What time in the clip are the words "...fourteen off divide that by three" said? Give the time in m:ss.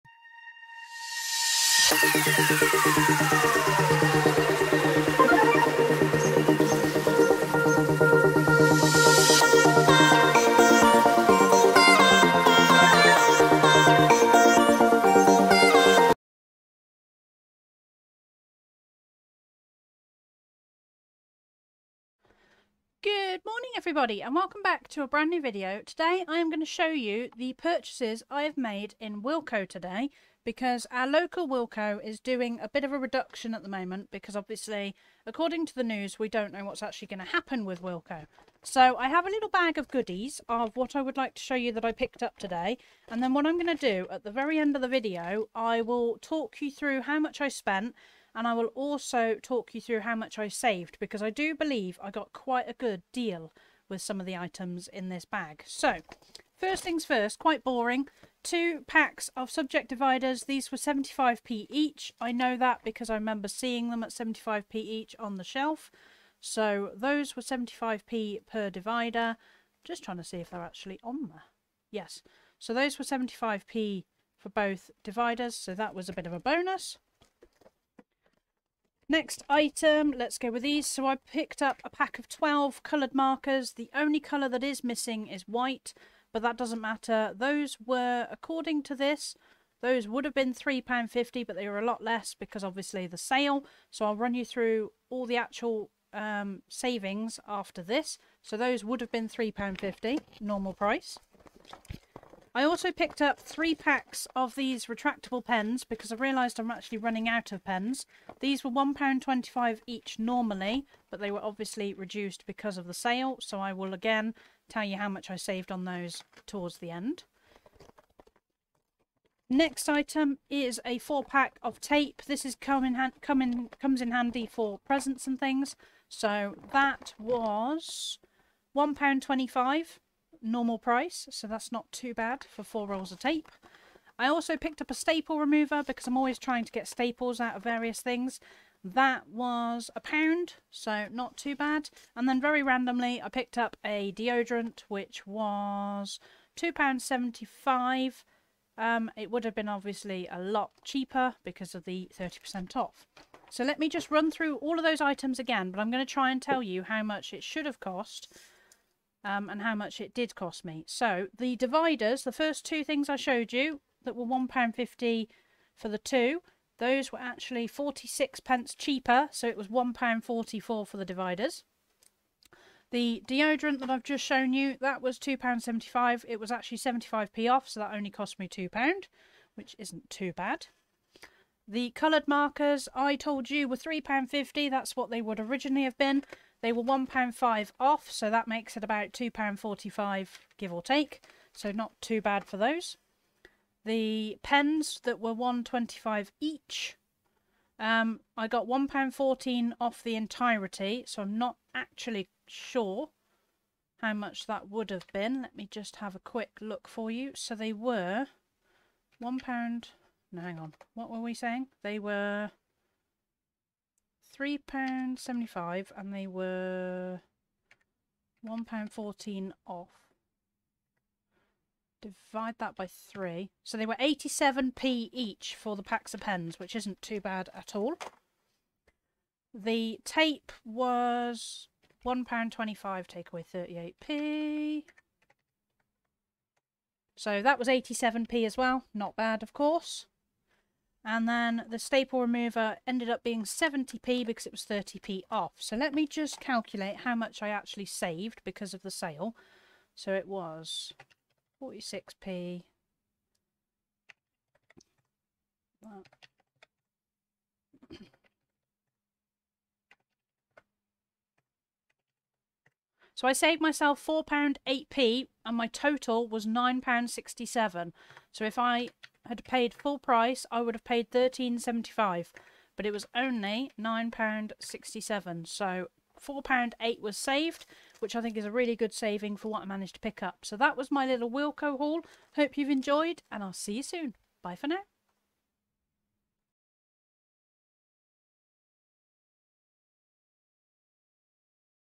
3:38.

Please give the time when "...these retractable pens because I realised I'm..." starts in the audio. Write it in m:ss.
1:44.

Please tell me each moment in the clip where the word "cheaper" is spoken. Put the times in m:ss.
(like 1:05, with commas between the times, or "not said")
2:30, 2:48.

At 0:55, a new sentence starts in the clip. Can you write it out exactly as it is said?
So First things first, quite boring.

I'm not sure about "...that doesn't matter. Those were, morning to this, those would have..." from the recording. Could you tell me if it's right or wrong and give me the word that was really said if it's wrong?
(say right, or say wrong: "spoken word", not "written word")
wrong: "according", not "morning".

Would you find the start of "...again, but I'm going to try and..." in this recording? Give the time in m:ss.
2:35.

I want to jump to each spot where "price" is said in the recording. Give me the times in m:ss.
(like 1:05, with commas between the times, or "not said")
1:40, 2:10, 4:29.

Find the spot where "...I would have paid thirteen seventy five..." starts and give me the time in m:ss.
4:30.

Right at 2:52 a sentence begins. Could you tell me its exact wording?
The deodorant that I've just shown you, that was £2.75.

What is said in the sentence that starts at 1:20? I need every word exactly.
So I picked up a pack of 12 coloured markers.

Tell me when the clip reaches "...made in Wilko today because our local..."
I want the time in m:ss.
0:28.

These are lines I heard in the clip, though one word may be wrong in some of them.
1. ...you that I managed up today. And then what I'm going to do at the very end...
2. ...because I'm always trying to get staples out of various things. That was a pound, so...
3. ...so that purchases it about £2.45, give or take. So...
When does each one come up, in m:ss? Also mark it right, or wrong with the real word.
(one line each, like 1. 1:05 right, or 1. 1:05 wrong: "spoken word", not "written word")
1. 0:41 wrong: "picked", not "managed"
2. 2:15 right
3. 3:08 wrong: "makes", not "purchases".